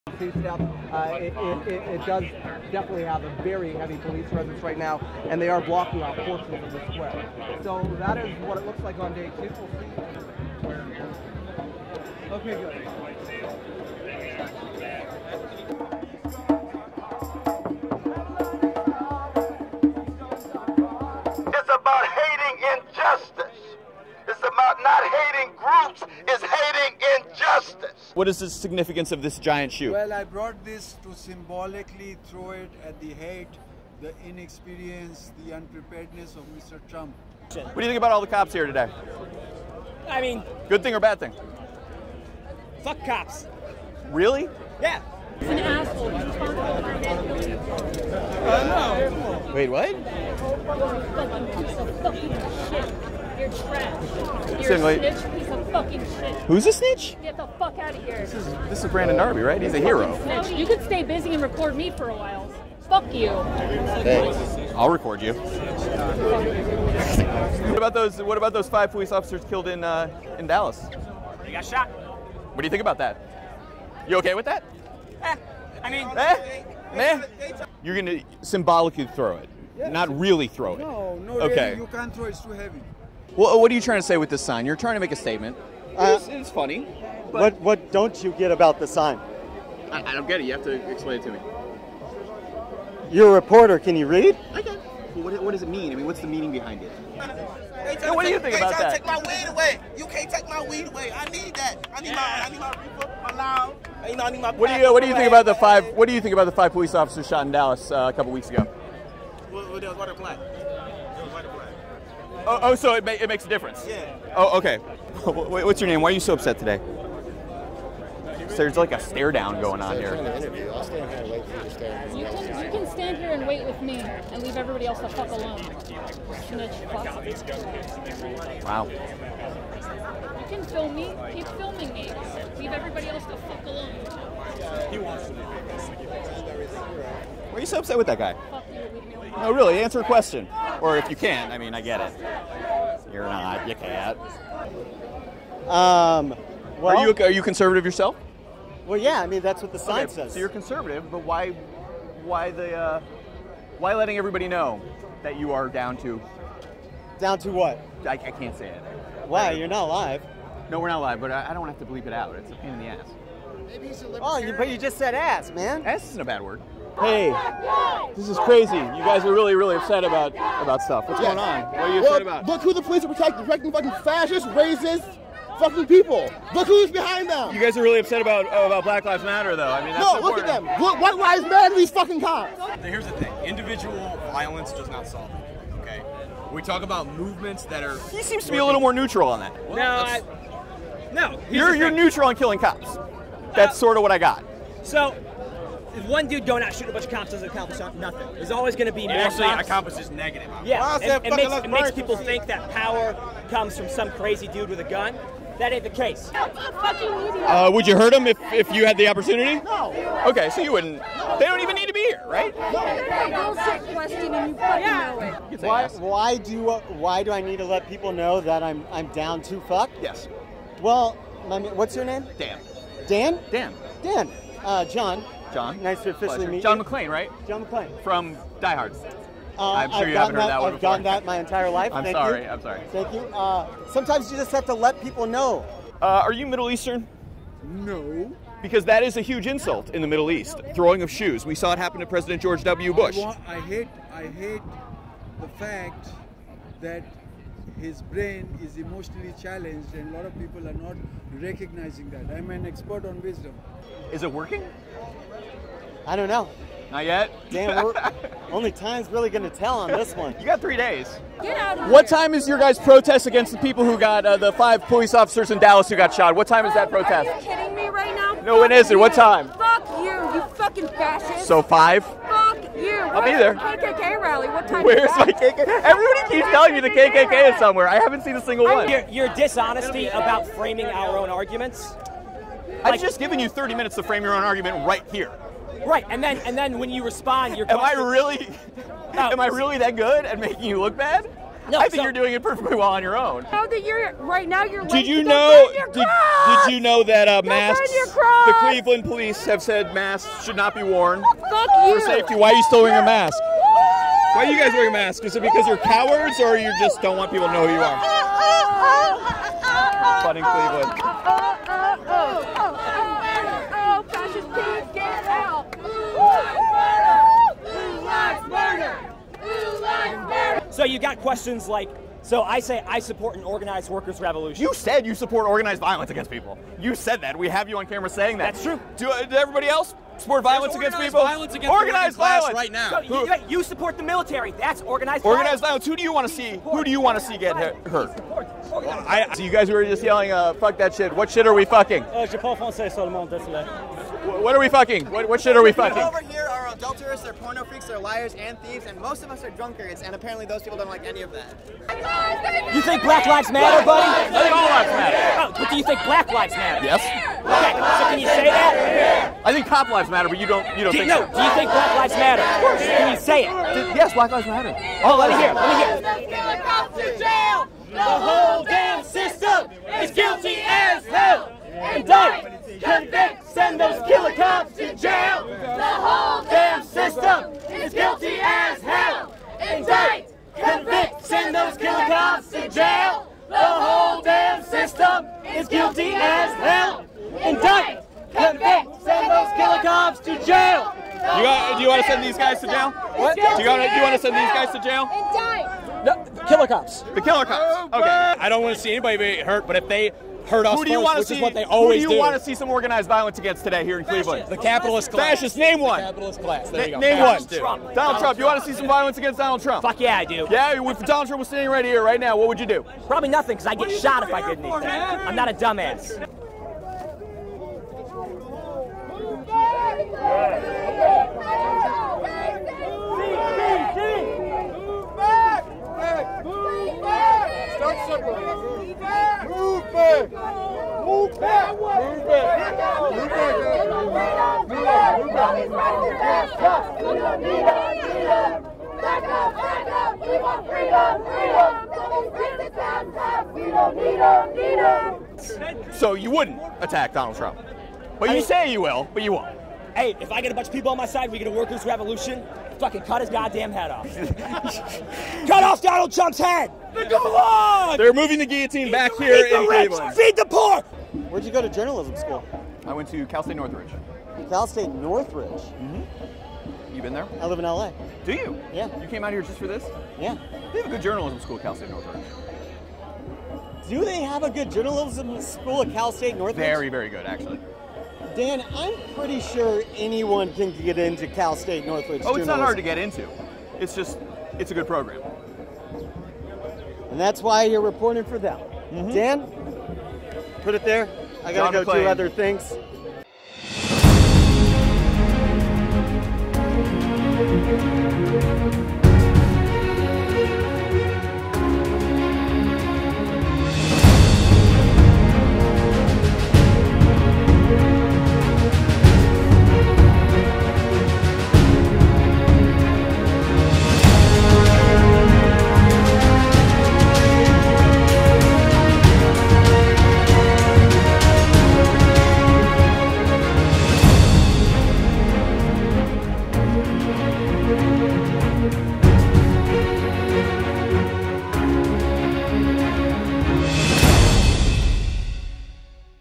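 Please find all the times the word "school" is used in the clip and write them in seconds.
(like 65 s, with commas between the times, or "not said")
462 s, 471 s, 475 s.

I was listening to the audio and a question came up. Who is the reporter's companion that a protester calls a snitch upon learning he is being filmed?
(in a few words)
Brandon Darby.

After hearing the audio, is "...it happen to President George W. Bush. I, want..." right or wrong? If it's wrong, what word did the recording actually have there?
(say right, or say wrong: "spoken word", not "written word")
right.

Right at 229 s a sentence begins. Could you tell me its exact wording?
Uh, I'm sure I've you haven't that, heard that one I've gotten that my entire life.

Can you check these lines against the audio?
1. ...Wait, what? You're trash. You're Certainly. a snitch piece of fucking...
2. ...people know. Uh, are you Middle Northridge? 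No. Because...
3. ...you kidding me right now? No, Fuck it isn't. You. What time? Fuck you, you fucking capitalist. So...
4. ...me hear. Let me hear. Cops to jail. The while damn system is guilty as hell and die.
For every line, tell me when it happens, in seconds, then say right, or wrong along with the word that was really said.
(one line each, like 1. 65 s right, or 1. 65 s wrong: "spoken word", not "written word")
1. 49 s right
2. 235 s wrong: "Eastern", not "Northridge"
3. 267 s wrong: "fascist", not "capitalist"
4. 365 s wrong: "whole", not "while".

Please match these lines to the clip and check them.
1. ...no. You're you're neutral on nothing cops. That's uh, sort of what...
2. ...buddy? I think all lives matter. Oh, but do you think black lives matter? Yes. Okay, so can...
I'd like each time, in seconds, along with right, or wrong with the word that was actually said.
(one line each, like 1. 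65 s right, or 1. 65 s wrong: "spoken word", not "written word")
1. 191 s wrong: "killing", not "nothing"
2. 353 s right.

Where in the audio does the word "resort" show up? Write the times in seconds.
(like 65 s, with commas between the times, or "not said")
not said.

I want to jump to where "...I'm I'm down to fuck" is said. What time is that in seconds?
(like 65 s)
218 s.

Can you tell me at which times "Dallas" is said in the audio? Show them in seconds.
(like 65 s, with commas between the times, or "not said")
70 s, 107 s, 265 s.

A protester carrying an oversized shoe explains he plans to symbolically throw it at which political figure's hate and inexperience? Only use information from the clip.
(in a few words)
Mr. Trump.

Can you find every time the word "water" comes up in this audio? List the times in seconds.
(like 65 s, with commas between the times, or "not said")
109 s.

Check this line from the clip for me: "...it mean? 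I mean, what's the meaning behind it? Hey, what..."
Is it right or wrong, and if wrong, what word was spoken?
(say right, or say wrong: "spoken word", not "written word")
right.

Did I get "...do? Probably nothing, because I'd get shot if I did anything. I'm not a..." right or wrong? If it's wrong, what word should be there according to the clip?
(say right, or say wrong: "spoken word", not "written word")
right.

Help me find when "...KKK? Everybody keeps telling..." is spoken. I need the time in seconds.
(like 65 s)
275 s.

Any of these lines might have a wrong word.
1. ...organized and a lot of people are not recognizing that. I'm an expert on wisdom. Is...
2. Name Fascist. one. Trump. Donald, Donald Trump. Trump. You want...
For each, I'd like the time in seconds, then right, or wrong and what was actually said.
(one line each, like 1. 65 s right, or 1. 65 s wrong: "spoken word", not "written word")
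1. 249 s wrong: "challenged", not "organized"
2. 406 s right.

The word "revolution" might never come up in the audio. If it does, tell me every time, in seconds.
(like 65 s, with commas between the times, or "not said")
324 s, 451 s.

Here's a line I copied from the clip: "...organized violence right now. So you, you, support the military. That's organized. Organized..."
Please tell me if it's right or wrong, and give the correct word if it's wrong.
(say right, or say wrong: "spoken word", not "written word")
right.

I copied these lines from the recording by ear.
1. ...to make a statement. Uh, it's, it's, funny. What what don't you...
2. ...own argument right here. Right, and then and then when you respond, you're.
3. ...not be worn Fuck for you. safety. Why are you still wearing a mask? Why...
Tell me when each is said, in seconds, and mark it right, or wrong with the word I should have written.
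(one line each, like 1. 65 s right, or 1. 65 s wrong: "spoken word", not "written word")
1. 84 s right
2. 284 s right
3. 300 s right.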